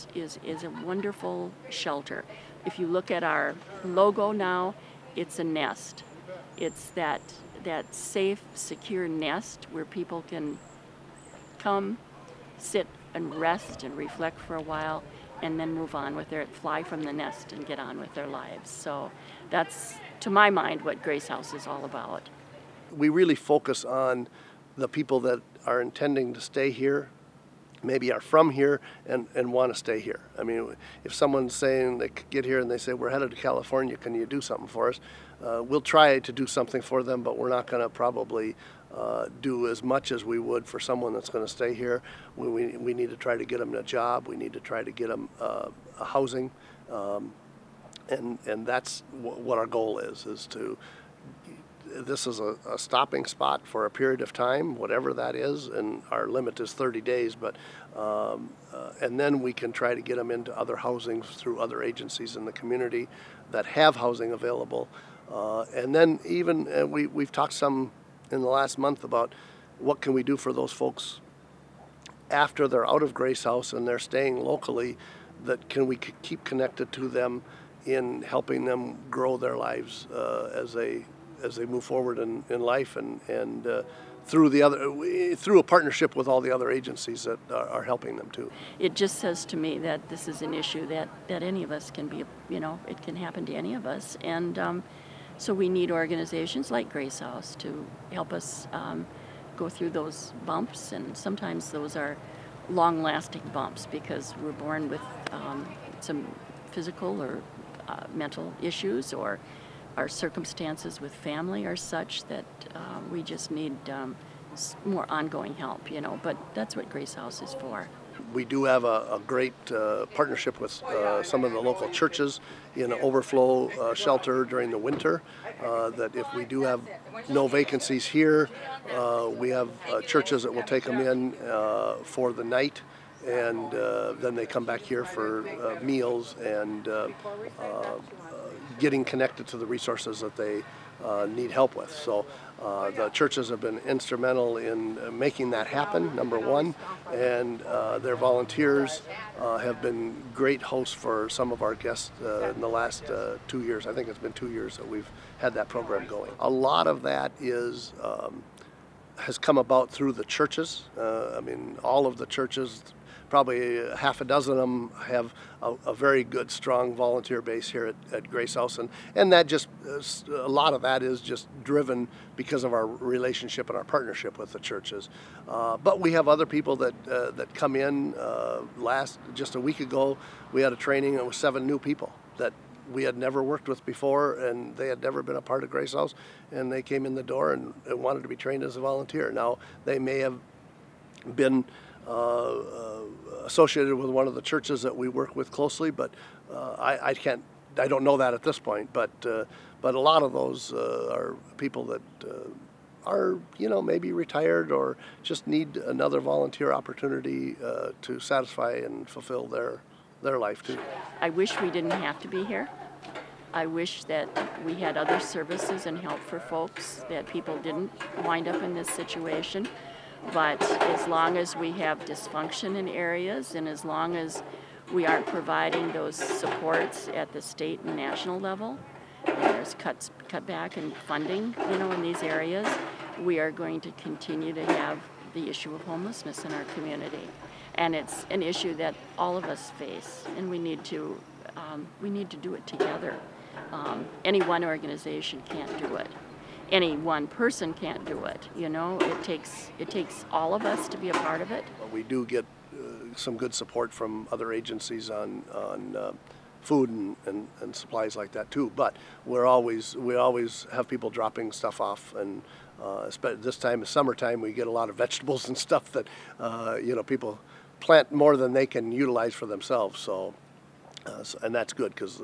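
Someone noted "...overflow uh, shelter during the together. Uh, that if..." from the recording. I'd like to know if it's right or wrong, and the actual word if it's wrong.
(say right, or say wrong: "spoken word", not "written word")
wrong: "winter", not "together".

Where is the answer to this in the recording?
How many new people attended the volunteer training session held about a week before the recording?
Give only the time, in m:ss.
3:01.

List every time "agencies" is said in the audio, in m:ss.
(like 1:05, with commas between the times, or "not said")
1:01, 1:26, 4:14.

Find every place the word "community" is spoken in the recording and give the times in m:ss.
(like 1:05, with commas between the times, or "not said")
1:02, 3:56.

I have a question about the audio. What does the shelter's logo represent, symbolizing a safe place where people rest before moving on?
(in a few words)
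A nest.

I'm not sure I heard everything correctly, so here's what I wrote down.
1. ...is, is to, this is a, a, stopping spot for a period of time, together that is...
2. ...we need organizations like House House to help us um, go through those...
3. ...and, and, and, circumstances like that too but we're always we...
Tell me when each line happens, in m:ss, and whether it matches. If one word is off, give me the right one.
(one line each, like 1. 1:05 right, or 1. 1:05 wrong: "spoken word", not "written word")
1. 0:49 wrong: "whatever", not "together"
2. 1:35 wrong: "Grace", not "House"
3. 4:16 wrong: "supplies", not "circumstances".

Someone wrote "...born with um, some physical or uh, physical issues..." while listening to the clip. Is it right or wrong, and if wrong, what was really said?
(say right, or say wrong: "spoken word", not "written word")
wrong: "mental", not "physical".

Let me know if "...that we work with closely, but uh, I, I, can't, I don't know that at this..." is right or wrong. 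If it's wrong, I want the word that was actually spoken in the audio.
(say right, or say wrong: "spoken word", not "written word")
right.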